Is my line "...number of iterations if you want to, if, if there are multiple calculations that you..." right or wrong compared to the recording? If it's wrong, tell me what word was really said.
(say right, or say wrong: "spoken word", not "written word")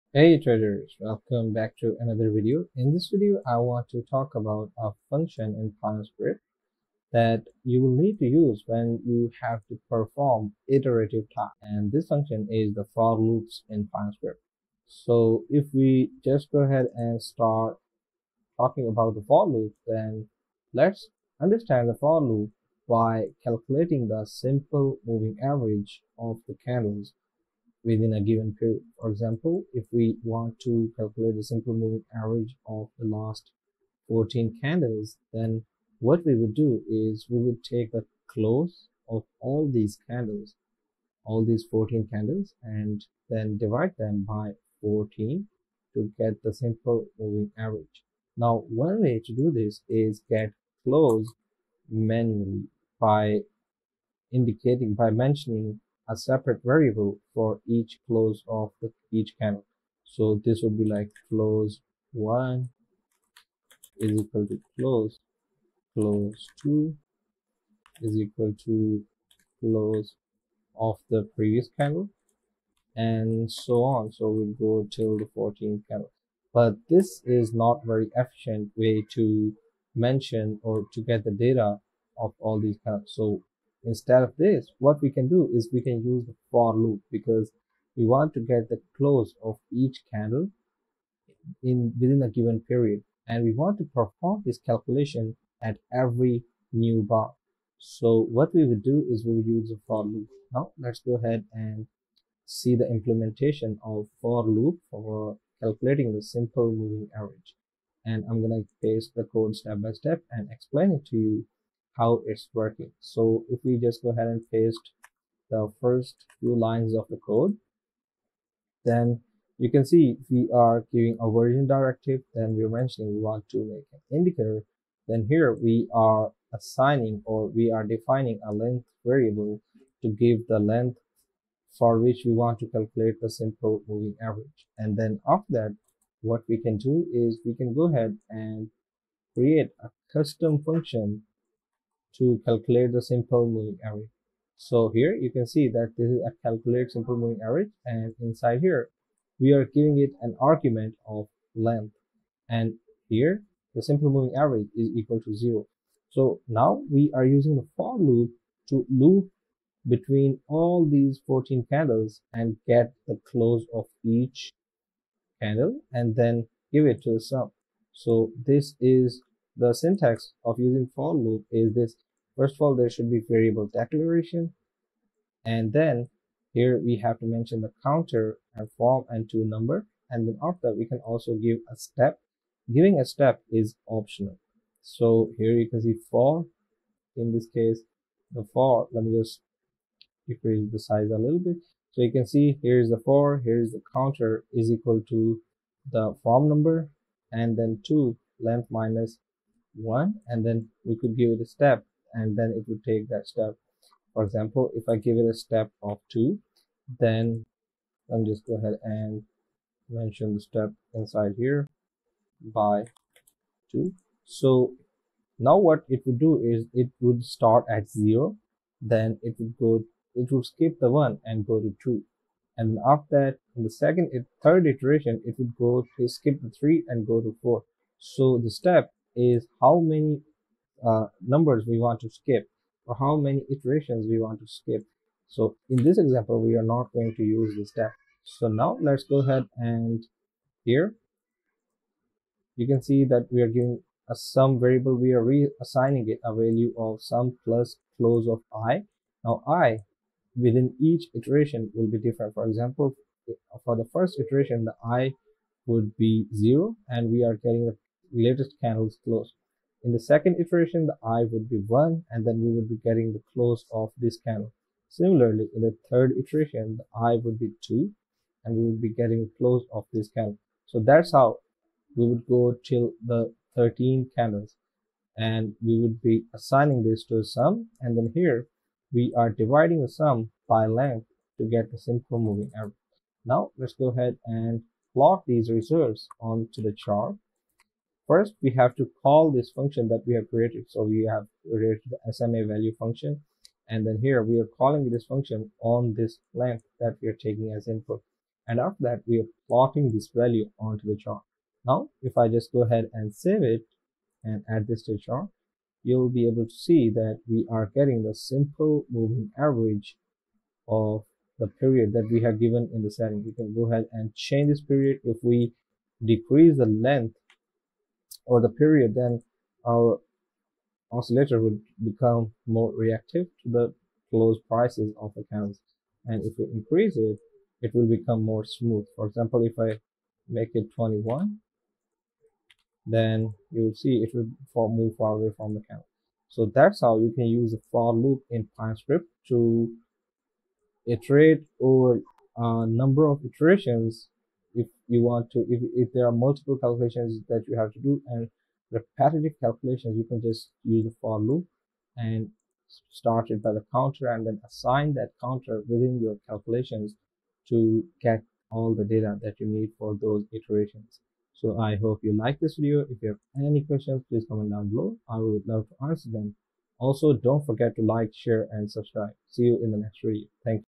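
right.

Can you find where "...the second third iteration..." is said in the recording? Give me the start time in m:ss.
3:43.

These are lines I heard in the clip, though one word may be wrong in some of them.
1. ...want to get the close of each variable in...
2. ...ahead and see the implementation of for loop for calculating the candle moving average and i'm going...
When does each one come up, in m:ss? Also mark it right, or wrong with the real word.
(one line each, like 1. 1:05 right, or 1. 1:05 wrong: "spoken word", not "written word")
1. 1:28 wrong: "candle", not "variable"
2. 1:41 wrong: "simple", not "candle".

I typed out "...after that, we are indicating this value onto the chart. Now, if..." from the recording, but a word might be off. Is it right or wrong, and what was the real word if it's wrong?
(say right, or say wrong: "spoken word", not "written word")
wrong: "plotting", not "indicating".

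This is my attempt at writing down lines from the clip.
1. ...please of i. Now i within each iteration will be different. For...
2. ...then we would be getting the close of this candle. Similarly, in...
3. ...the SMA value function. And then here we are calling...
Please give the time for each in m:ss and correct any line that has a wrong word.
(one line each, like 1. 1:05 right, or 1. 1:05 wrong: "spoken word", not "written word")
1. 4:07 wrong: "close", not "please"
2. 4:22 right
3. 4:51 right.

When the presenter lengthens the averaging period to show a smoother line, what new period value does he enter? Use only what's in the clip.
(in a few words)
21.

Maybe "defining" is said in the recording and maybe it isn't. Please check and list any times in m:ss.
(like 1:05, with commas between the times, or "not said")
2:07.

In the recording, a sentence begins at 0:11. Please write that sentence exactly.
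And this function is the for loops in Pine Script.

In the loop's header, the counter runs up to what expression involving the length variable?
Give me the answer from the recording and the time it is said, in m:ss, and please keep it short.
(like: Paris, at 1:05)
length minus one, at 3:18.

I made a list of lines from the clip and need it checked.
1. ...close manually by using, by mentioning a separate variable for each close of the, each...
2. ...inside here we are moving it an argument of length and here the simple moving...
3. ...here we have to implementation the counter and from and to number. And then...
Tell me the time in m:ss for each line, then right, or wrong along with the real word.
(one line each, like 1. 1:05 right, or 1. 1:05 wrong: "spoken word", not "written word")
1. 0:50 wrong: "indicating", not "using"
2. 2:28 wrong: "giving", not "moving"
3. 2:56 wrong: "mention", not "implementation".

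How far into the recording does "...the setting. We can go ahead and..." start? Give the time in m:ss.
5:12.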